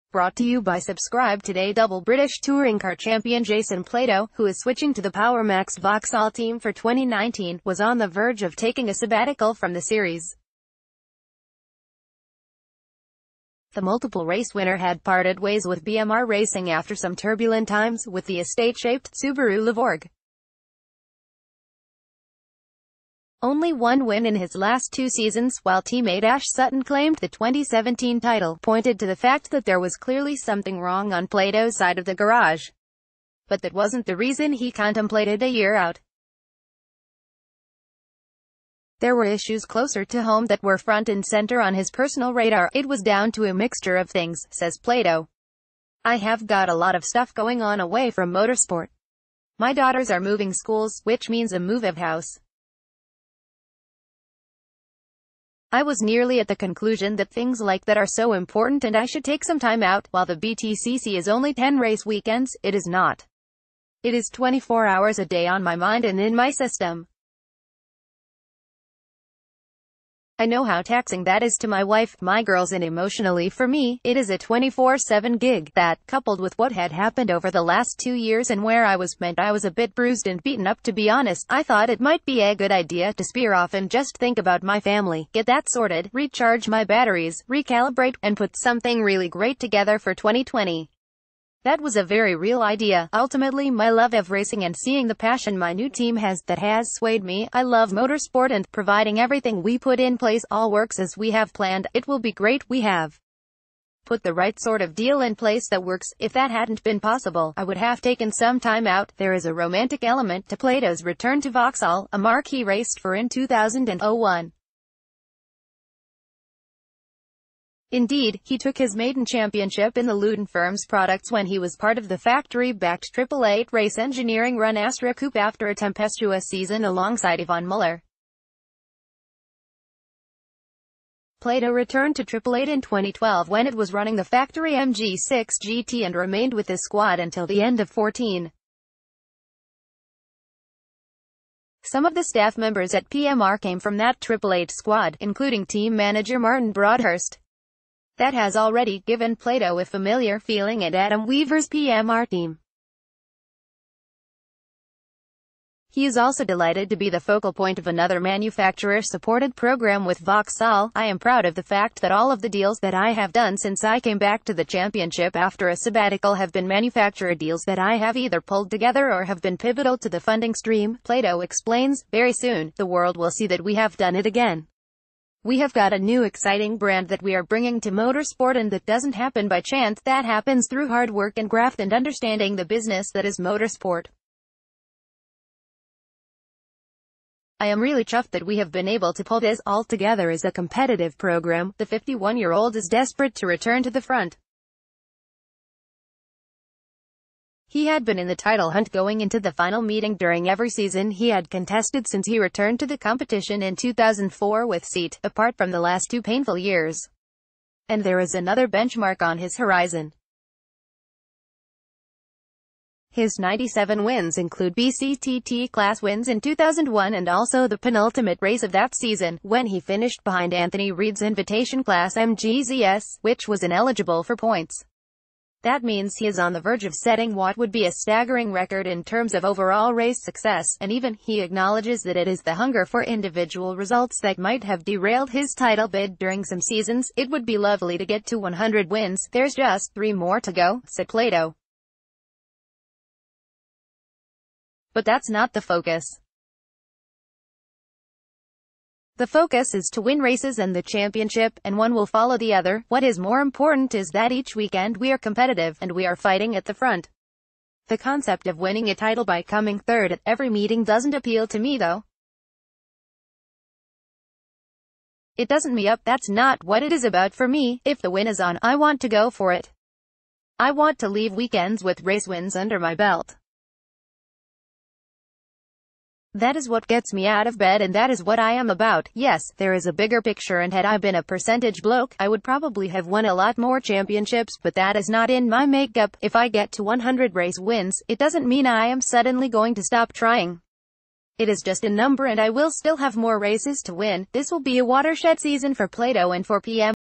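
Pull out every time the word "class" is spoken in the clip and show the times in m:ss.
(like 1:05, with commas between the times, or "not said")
3:35, 3:41.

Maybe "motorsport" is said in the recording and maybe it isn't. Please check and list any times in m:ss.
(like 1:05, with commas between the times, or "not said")
0:48, 1:37, 2:57, 3:03.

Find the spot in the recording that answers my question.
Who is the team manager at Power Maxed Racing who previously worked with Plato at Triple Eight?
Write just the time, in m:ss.
2:26.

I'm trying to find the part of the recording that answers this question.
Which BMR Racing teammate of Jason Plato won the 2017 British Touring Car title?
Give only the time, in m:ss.
0:26.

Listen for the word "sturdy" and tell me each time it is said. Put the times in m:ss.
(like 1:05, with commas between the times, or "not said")
not said.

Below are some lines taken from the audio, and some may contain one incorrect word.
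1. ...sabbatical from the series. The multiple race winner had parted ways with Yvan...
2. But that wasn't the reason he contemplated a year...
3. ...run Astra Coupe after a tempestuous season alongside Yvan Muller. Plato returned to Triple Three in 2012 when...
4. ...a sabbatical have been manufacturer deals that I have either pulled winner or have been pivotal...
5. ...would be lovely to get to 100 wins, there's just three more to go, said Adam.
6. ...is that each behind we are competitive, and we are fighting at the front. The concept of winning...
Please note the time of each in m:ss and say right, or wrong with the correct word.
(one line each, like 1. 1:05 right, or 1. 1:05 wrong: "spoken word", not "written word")
1. 0:08 wrong: "BMR", not "Yvan"
2. 0:33 right
3. 2:04 wrong: "Eight", not "Three"
4. 2:45 wrong: "together", not "winner"
5. 3:57 wrong: "Plato", not "Adam"
6. 4:13 wrong: "weekend", not "behind".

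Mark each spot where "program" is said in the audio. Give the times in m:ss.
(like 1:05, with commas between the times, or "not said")
2:39, 3:11.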